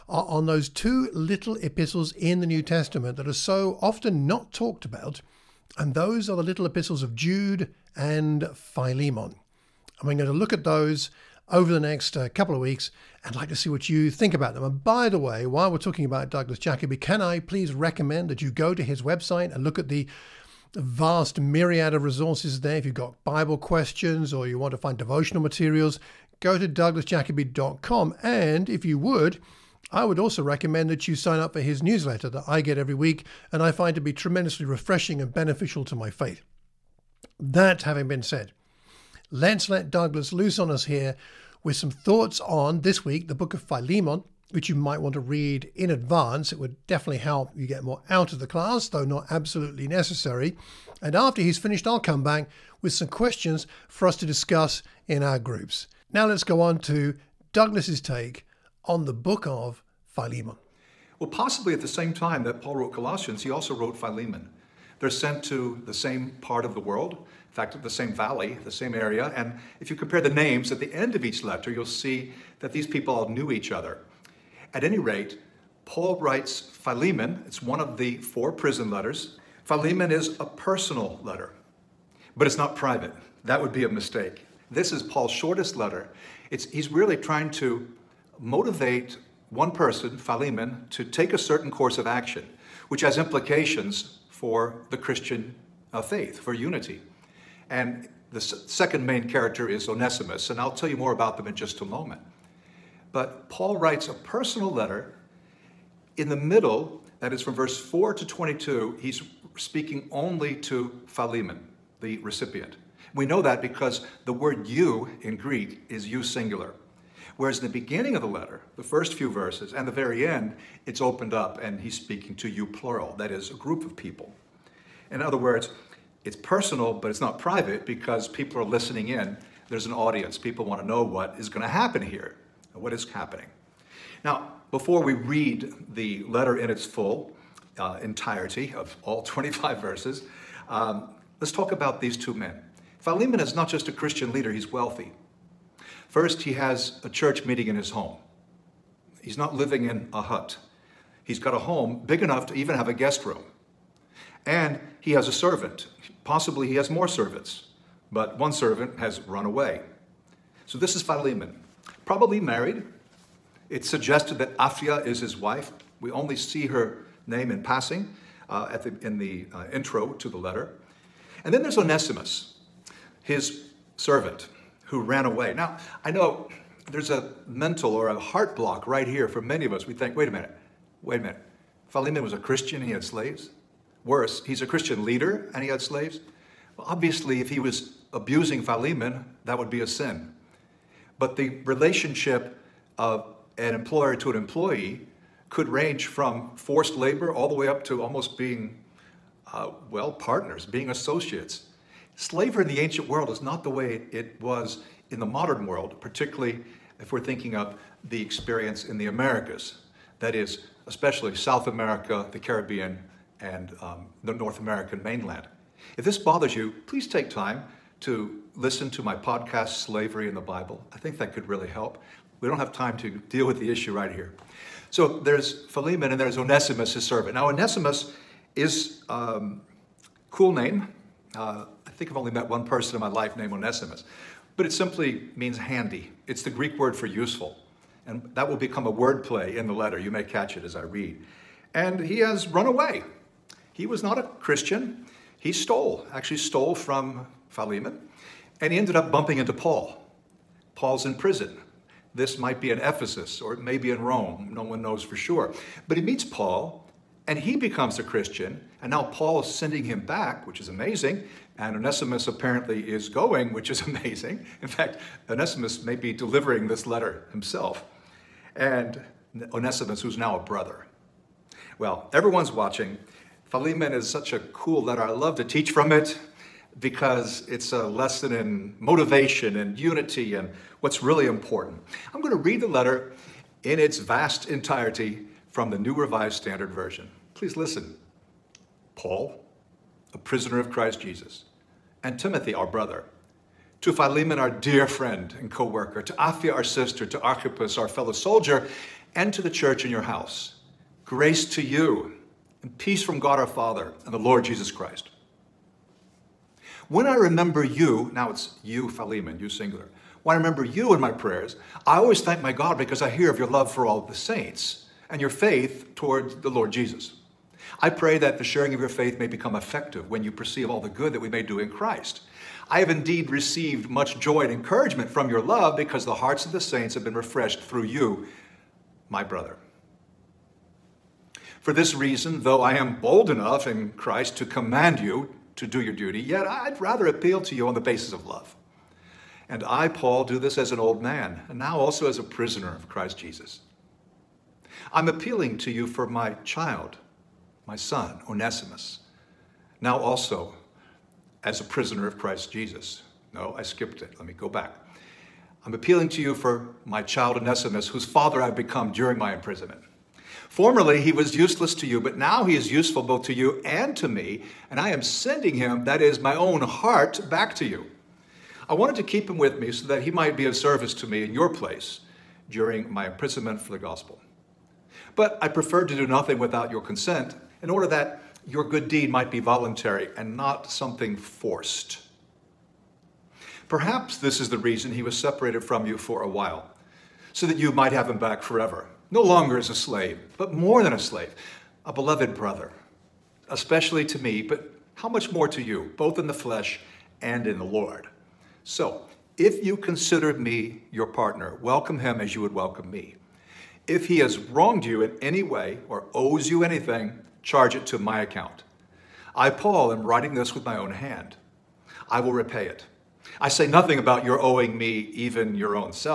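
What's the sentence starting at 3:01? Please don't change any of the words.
Philemon was a Christian and he had slaves.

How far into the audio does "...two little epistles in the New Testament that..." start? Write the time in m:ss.
0:00.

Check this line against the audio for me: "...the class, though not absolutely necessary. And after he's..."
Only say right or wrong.
right.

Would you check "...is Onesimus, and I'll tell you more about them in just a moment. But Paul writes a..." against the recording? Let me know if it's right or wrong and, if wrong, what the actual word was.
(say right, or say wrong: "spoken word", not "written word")
right.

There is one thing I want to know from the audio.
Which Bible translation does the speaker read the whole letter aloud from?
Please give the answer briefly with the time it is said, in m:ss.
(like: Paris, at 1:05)
New Revised Standard Version, at 4:45.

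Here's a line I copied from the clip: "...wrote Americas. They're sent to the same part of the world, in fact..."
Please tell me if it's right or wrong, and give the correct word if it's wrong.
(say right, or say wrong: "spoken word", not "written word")
wrong: "Philemon", not "Americas".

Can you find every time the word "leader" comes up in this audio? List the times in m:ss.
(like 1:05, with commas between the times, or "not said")
2:24, 3:05.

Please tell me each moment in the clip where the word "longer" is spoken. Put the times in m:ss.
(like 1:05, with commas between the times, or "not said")
6:29.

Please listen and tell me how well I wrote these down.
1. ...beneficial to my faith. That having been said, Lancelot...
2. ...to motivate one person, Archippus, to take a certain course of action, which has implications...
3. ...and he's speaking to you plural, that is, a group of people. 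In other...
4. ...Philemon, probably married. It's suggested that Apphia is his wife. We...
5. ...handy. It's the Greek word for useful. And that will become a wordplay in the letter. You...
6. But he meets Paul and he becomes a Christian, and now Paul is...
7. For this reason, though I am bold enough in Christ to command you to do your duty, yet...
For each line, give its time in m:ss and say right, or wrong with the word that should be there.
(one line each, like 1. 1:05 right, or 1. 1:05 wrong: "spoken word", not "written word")
1. 0:35 right
2. 1:27 wrong: "Philemon", not "Archippus"
3. 2:01 right
4. 2:41 right
5. 3:55 right
6. 4:15 right
7. 5:31 right.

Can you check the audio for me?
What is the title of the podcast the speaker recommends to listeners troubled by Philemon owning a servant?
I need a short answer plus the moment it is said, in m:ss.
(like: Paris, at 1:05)
Slavery in the Bible, at 3:39.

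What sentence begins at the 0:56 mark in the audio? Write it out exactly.
Now let's go on to Douglas's take on the book of Philemon.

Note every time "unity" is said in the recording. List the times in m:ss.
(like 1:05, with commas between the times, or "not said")
1:36, 4:39.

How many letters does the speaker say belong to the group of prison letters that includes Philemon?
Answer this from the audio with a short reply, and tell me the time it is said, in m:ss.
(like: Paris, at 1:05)
4, at 1:18.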